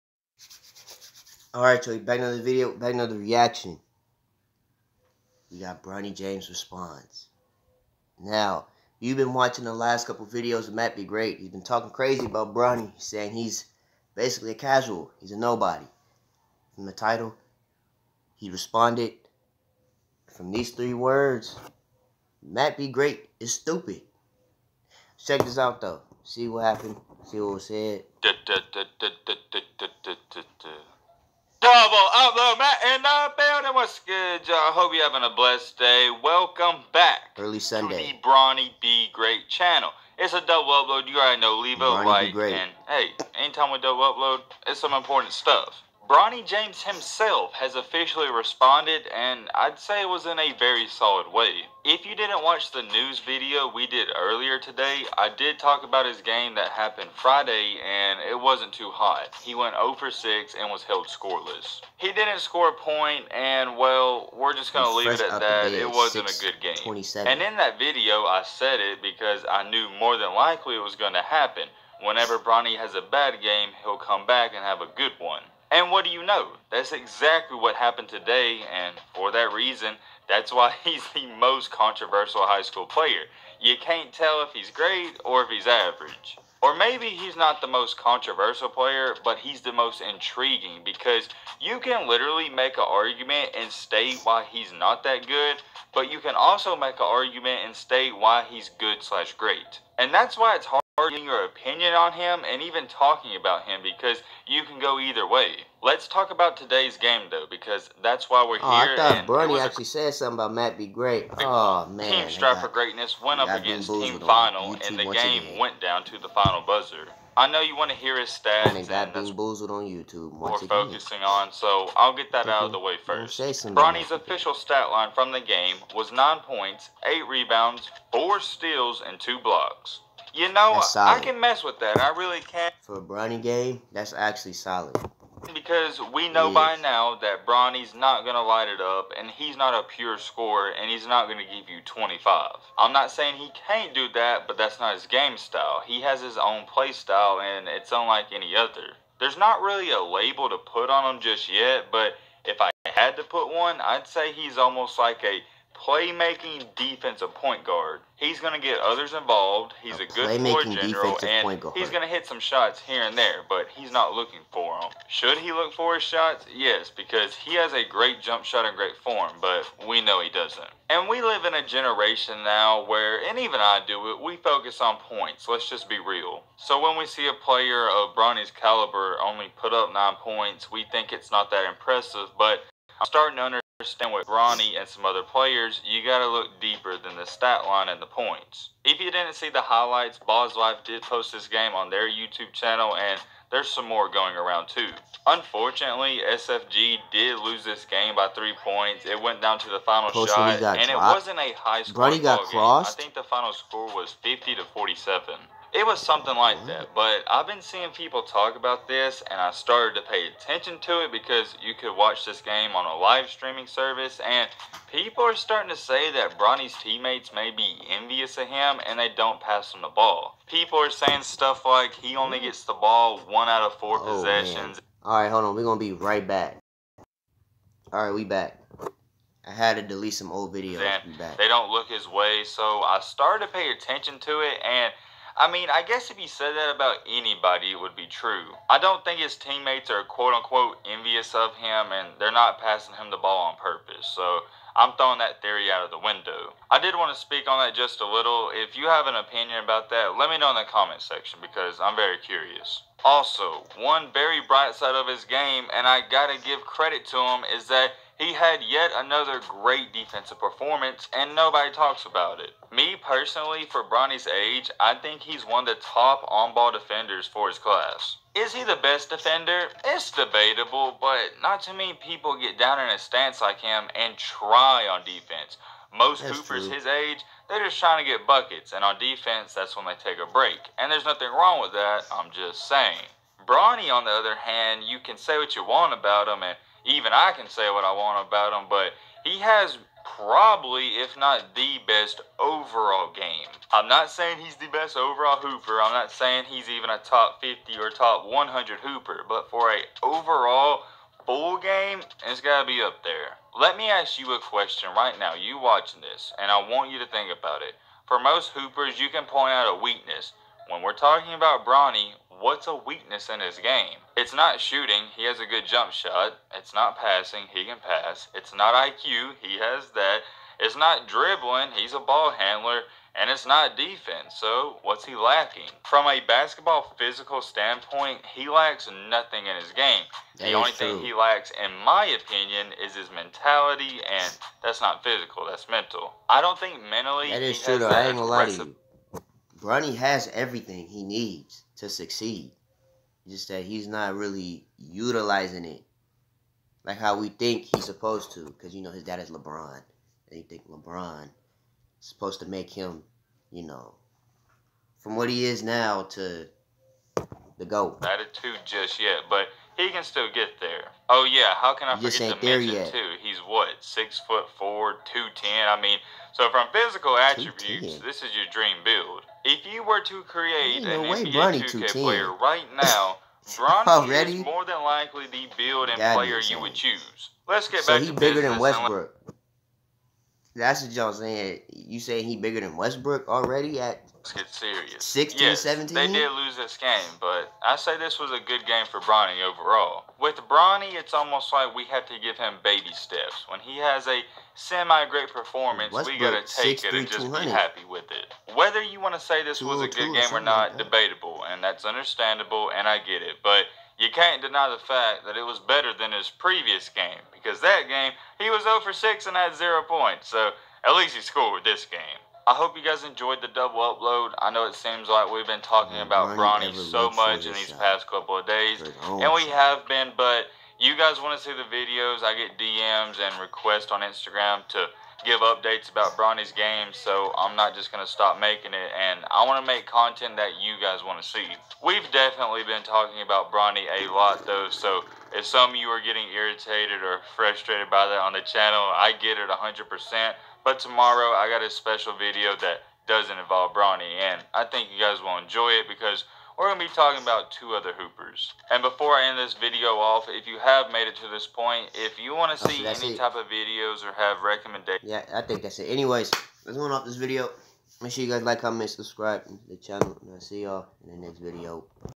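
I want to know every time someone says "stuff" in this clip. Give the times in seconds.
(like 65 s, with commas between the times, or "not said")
45 s, 221 s.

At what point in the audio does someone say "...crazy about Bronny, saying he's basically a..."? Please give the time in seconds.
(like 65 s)
11 s.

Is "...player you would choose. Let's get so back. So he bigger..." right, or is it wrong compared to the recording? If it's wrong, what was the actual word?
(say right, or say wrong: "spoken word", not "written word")
right.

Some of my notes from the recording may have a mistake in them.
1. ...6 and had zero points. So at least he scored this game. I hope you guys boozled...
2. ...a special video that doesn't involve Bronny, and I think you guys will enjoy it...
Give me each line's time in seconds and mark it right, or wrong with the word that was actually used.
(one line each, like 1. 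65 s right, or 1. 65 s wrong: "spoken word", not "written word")
1. 408 s wrong: "enjoyed", not "boozled"
2. 441 s right.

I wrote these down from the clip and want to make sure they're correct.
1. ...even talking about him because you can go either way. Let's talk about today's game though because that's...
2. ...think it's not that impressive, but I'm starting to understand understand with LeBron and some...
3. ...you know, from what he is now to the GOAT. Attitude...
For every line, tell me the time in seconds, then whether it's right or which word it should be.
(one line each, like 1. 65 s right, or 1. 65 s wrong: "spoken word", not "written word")
1. 102 s right
2. 180 s wrong: "Bronny", not "LeBron"
3. 353 s right.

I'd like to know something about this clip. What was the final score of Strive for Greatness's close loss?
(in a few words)
50 to 47.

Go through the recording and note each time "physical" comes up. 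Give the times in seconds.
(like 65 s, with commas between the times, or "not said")
326 s, 335 s, 366 s.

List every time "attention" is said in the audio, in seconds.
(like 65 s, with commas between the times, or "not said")
210 s, 233 s.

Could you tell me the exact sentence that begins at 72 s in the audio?
Whenever Bronny has a bad game, he'll come back and have a good one.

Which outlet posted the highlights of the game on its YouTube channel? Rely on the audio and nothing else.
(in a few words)
Ball's Life.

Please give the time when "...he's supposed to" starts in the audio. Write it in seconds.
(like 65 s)
347 s.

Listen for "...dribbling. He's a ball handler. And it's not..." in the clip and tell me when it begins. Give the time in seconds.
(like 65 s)
321 s.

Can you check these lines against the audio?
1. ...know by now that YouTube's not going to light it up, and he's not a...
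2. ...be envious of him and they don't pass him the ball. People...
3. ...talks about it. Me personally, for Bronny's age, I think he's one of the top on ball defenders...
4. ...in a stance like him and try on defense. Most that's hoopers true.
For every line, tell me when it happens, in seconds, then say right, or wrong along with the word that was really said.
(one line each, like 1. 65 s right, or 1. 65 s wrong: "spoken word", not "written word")
1. 136 s wrong: "Bronny", not "YouTube"
2. 217 s right
3. 261 s right
4. 272 s right.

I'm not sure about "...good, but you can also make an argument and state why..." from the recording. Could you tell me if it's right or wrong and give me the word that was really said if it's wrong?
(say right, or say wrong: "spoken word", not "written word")
right.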